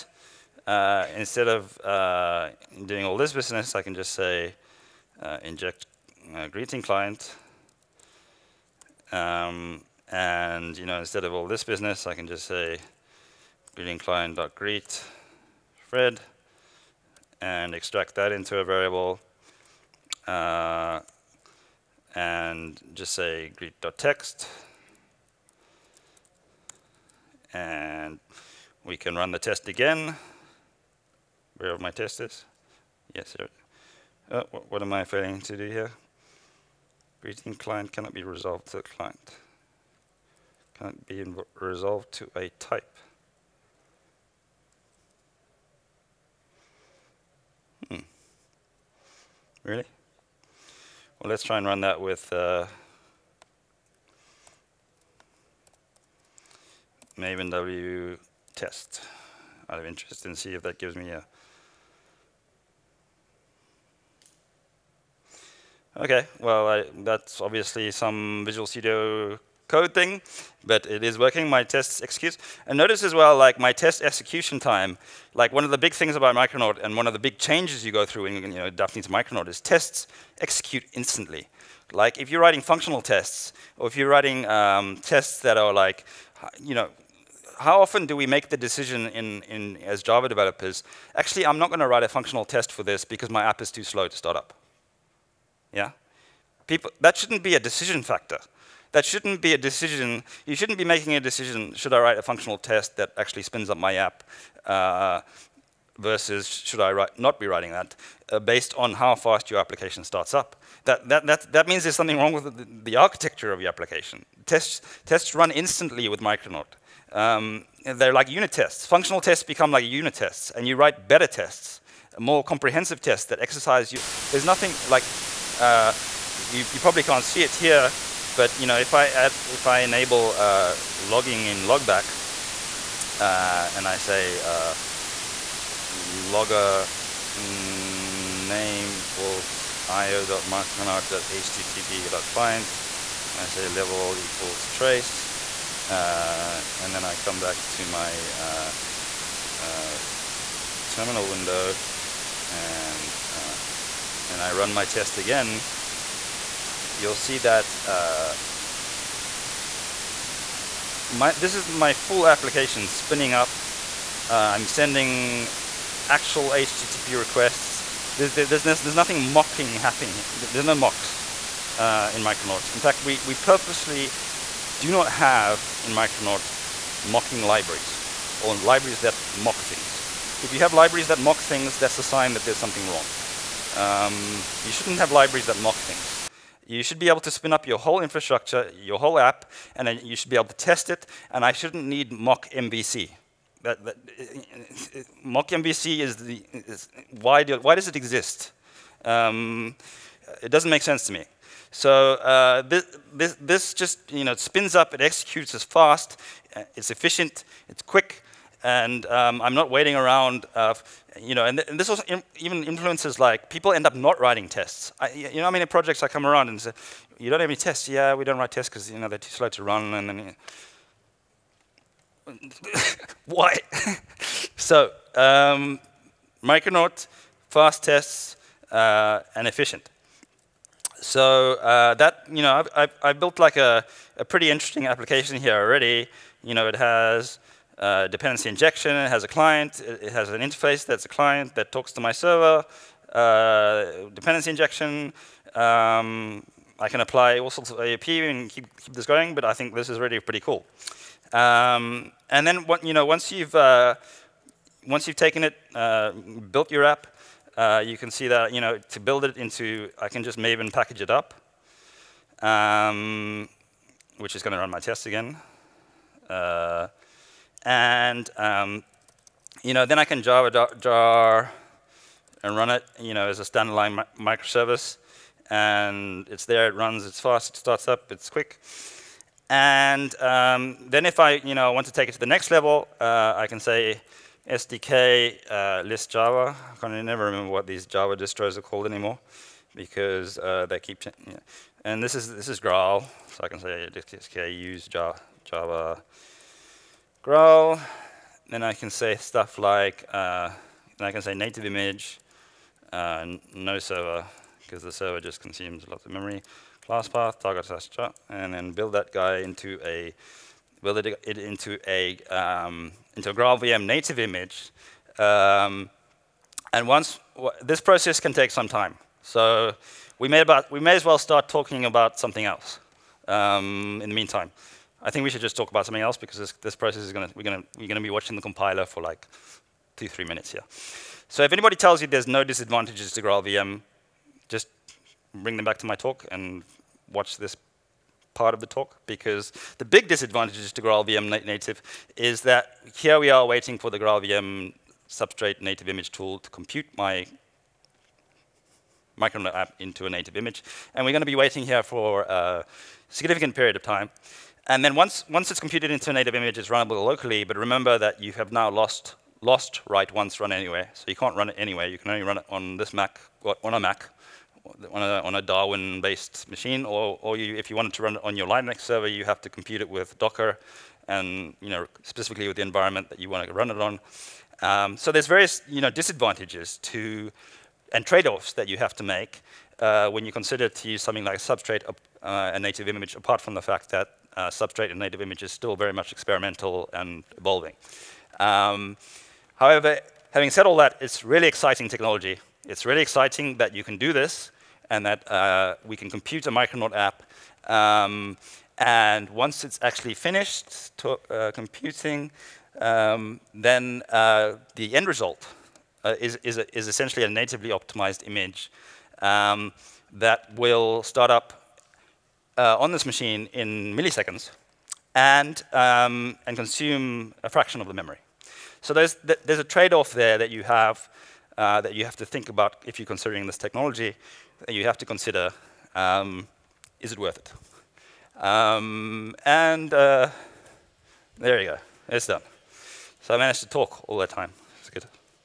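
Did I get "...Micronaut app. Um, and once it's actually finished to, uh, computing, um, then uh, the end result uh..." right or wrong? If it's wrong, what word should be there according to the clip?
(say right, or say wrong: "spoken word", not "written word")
right.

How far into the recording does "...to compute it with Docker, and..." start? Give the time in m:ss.
6:09.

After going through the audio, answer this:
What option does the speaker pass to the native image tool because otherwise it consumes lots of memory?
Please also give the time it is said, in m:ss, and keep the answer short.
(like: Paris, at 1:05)
no server, at 5:03.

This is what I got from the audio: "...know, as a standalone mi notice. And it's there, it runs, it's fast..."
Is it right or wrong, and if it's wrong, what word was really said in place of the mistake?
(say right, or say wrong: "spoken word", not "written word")
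wrong: "microservice", not "notice".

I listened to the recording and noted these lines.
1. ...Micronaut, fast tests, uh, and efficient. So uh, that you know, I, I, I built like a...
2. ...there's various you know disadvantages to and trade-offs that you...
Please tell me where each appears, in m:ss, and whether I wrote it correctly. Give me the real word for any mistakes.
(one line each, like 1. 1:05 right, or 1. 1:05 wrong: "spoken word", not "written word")
1. 3:46 right
2. 6:15 right.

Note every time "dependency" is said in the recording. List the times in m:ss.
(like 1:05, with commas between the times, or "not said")
3:58, 4:04.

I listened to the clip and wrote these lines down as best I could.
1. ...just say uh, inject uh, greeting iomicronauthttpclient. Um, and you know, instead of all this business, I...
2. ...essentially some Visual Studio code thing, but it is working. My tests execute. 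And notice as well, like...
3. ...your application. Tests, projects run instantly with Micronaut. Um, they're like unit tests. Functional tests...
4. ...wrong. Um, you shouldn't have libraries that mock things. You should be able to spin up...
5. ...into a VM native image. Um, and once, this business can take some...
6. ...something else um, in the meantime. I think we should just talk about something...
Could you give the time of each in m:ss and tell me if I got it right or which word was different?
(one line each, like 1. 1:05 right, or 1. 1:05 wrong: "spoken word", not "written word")
1. 0:03 wrong: "client", not "iomicronauthttpclient"
2. 1:07 wrong: "obviously", not "essentially"
3. 1:53 wrong: "tests", not "projects"
4. 3:02 right
5. 5:13 wrong: "process", not "business"
6. 5:22 right.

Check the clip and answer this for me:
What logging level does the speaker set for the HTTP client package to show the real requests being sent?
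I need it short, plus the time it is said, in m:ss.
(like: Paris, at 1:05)
trace, at 2:24.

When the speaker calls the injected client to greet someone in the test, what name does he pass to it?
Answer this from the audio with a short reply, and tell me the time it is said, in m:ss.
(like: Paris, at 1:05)
Fred, at 0:15.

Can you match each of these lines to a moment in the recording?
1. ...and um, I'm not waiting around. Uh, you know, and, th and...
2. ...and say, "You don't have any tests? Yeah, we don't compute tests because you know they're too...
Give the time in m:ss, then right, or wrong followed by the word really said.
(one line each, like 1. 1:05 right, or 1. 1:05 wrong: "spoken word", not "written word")
1. 3:28 right
2. 3:36 wrong: "write", not "compute".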